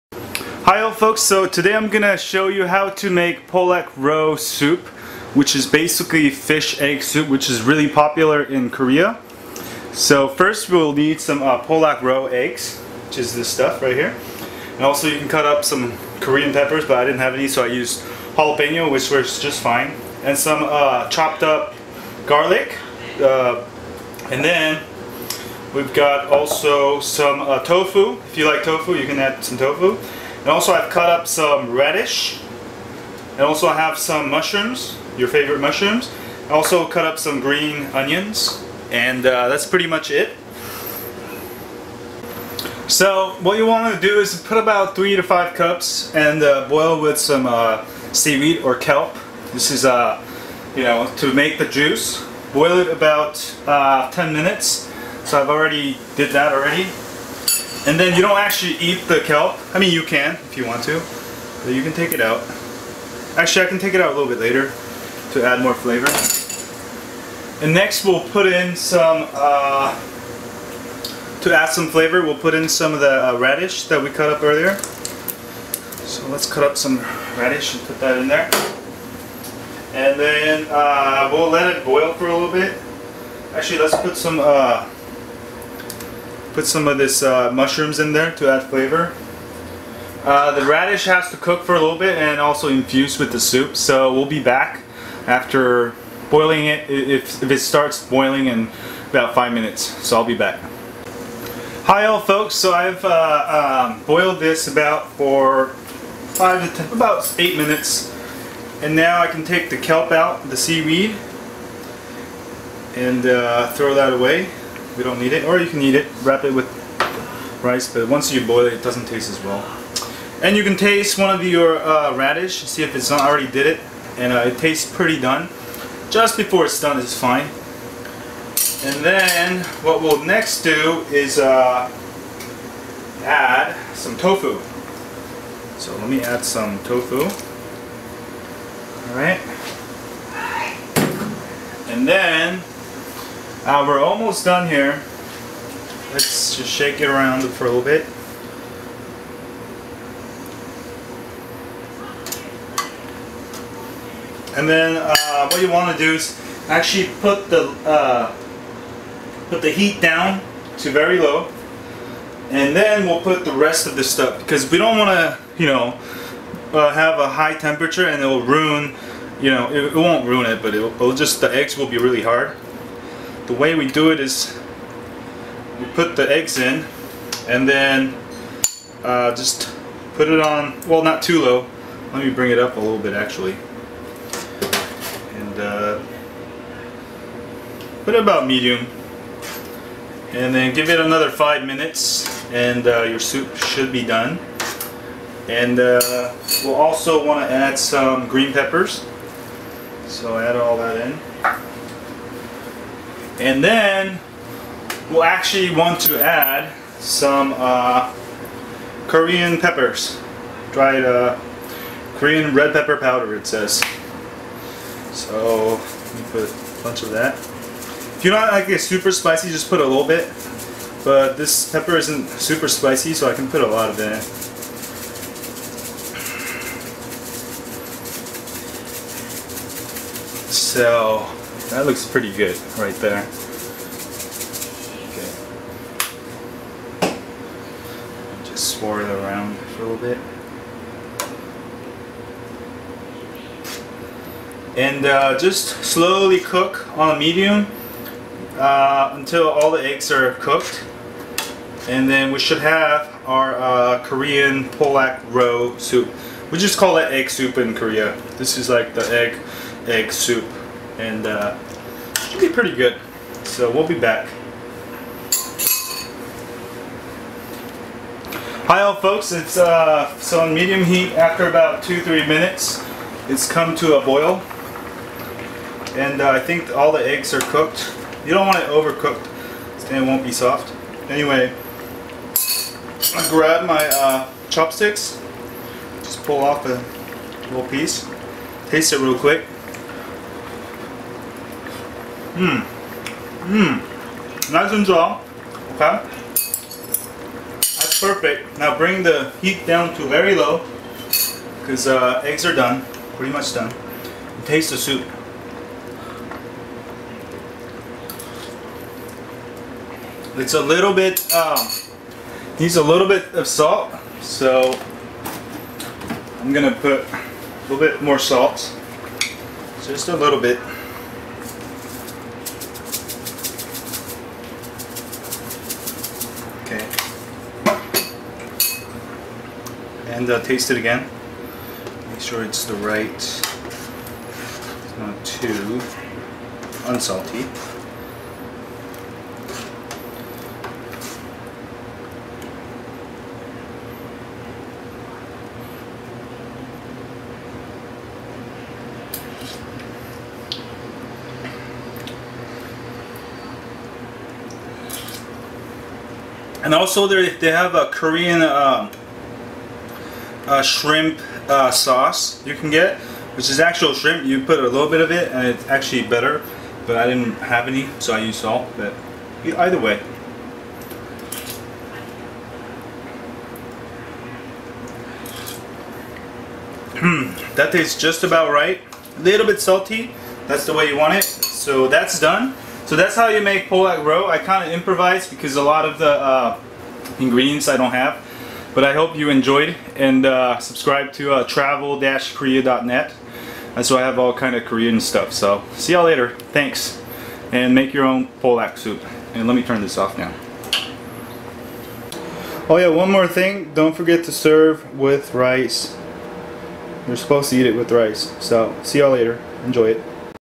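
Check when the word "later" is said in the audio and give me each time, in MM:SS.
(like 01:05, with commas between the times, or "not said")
01:04, 06:36, 06:49.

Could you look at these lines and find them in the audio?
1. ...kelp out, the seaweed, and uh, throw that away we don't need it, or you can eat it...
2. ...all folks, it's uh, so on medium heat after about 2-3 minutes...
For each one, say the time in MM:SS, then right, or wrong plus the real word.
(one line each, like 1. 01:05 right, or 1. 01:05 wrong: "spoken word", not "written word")
1. 01:49 right
2. 04:28 right.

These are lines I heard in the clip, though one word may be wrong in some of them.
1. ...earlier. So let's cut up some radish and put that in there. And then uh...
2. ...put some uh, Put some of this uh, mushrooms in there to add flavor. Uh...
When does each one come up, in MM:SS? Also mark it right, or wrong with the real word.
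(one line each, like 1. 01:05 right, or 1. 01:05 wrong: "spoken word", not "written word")
1. 01:14 right
2. 01:24 right.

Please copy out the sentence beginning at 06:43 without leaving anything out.
Don't forget to serve with rice.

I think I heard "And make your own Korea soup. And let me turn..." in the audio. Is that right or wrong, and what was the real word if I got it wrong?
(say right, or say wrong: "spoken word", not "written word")
wrong: "Pollock", not "Korea".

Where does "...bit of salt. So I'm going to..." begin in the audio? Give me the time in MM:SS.
05:13.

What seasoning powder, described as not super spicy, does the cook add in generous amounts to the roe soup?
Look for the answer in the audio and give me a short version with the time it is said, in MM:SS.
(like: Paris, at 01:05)
Korean red pepper powder, at 03:32.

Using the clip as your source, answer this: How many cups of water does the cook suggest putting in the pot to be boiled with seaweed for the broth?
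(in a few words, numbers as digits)
3 to 5 cups.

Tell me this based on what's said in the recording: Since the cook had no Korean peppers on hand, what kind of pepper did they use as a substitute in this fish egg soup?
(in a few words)
jalapeno.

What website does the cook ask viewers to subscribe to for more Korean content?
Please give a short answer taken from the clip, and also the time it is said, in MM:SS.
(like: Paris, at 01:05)
travel-korea.net, at 06:31.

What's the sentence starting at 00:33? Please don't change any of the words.
And also I have some mushrooms, your favorite mushrooms.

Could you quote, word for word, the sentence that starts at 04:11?
And then we should have our uh, Korean pollock roe soup.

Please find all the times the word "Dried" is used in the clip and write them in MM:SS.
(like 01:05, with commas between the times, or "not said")
03:30.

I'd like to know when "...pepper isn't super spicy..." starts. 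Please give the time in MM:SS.
03:41.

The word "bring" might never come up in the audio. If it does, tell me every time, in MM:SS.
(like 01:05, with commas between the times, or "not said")
03:02, 04:58.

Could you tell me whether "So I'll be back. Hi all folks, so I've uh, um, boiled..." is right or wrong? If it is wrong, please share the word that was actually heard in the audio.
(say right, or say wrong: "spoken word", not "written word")
right.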